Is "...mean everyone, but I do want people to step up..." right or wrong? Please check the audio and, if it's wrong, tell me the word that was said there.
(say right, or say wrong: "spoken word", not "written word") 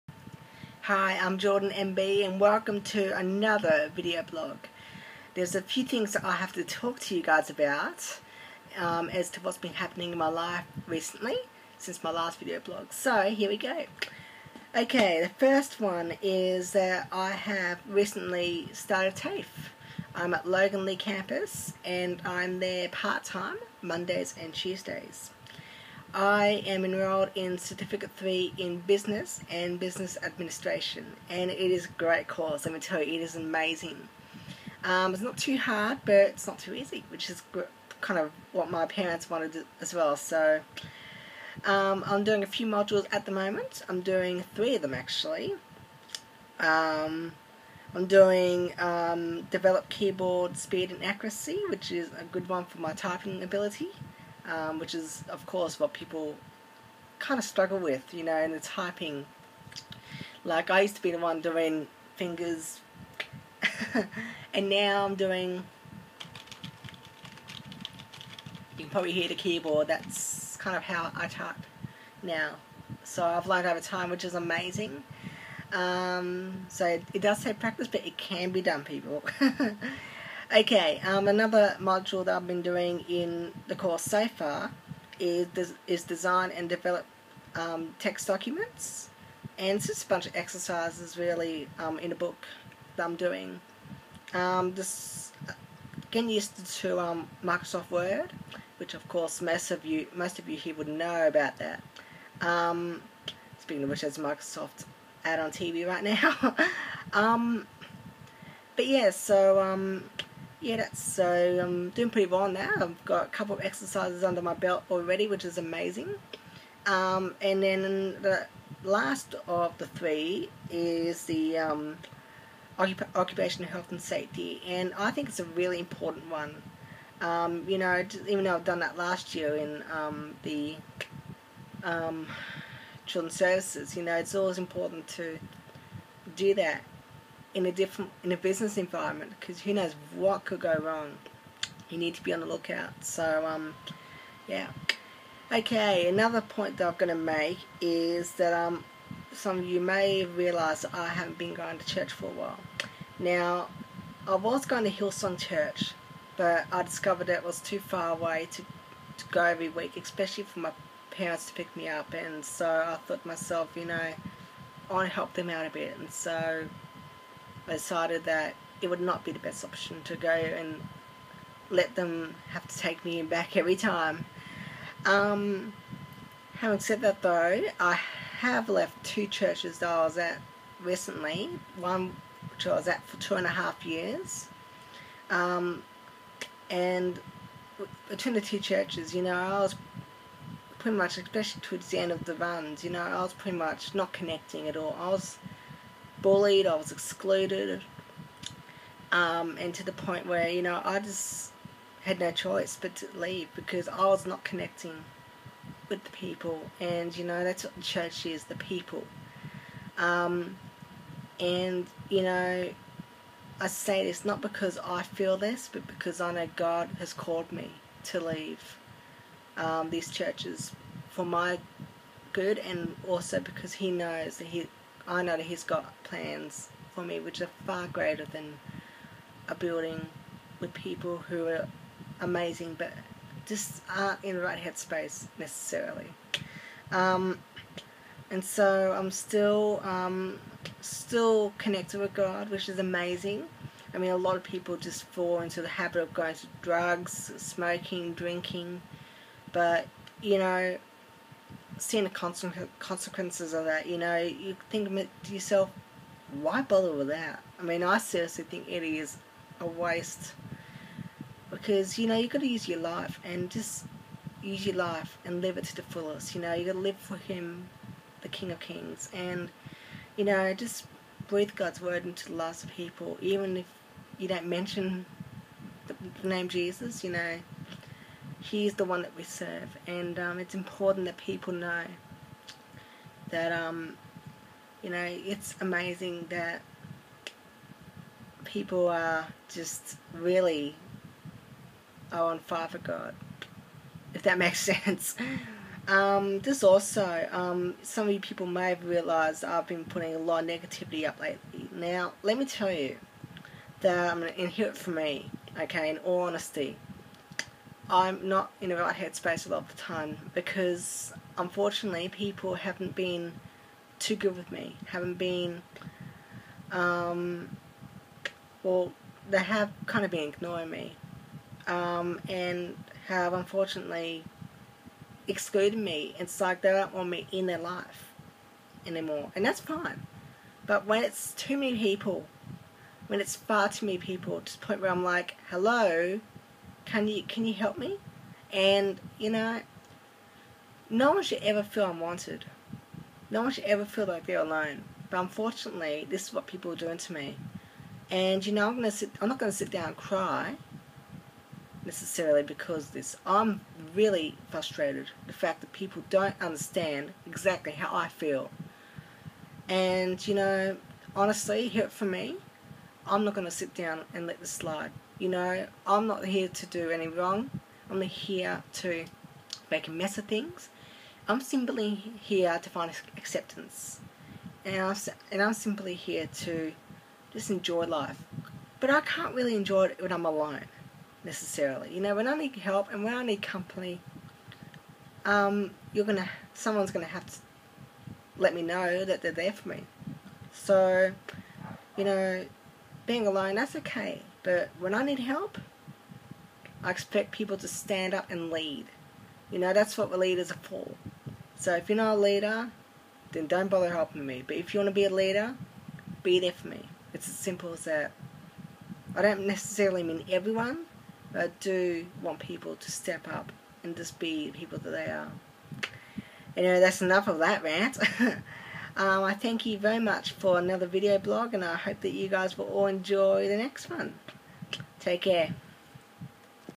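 right.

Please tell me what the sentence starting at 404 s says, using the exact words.
But if you want to be a leader, be there for me.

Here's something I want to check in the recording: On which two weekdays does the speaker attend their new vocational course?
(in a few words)
Mondays and Tuesdays.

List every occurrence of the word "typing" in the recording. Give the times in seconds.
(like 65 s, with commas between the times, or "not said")
52 s, 58 s.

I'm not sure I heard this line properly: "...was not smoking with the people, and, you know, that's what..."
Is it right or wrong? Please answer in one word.
wrong.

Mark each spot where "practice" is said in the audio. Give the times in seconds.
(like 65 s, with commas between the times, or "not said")
77 s.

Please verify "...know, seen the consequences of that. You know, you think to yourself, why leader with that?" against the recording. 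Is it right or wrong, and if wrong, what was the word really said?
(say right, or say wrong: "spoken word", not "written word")
wrong: "bother", not "leader".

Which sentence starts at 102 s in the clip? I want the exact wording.
Um, speaking of which, there's Microsoft ad on TV right now.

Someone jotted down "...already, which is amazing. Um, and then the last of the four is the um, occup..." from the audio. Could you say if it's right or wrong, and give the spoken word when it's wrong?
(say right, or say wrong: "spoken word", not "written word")
wrong: "three", not "four".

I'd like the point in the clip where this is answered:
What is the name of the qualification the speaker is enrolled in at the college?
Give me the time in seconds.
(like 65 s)
27 s.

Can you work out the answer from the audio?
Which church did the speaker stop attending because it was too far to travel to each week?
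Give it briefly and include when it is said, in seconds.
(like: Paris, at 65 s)
Hillsong Church, at 154 s.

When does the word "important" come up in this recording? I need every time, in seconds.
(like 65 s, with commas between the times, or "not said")
125 s, 134 s, 280 s.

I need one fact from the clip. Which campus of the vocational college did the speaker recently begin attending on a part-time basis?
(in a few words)
Loganlea.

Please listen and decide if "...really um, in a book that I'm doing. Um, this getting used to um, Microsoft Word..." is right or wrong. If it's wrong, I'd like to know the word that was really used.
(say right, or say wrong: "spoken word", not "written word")
right.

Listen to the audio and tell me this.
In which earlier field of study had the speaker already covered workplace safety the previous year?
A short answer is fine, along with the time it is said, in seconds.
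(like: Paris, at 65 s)
children's services, at 133 s.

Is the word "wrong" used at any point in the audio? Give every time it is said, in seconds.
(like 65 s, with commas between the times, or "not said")
140 s, 367 s.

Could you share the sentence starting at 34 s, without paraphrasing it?
Um, it's not too hard, but it's not too easy, which is kind of what my parents wanted as well.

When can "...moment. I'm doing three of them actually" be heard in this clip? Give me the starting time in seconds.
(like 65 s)
43 s.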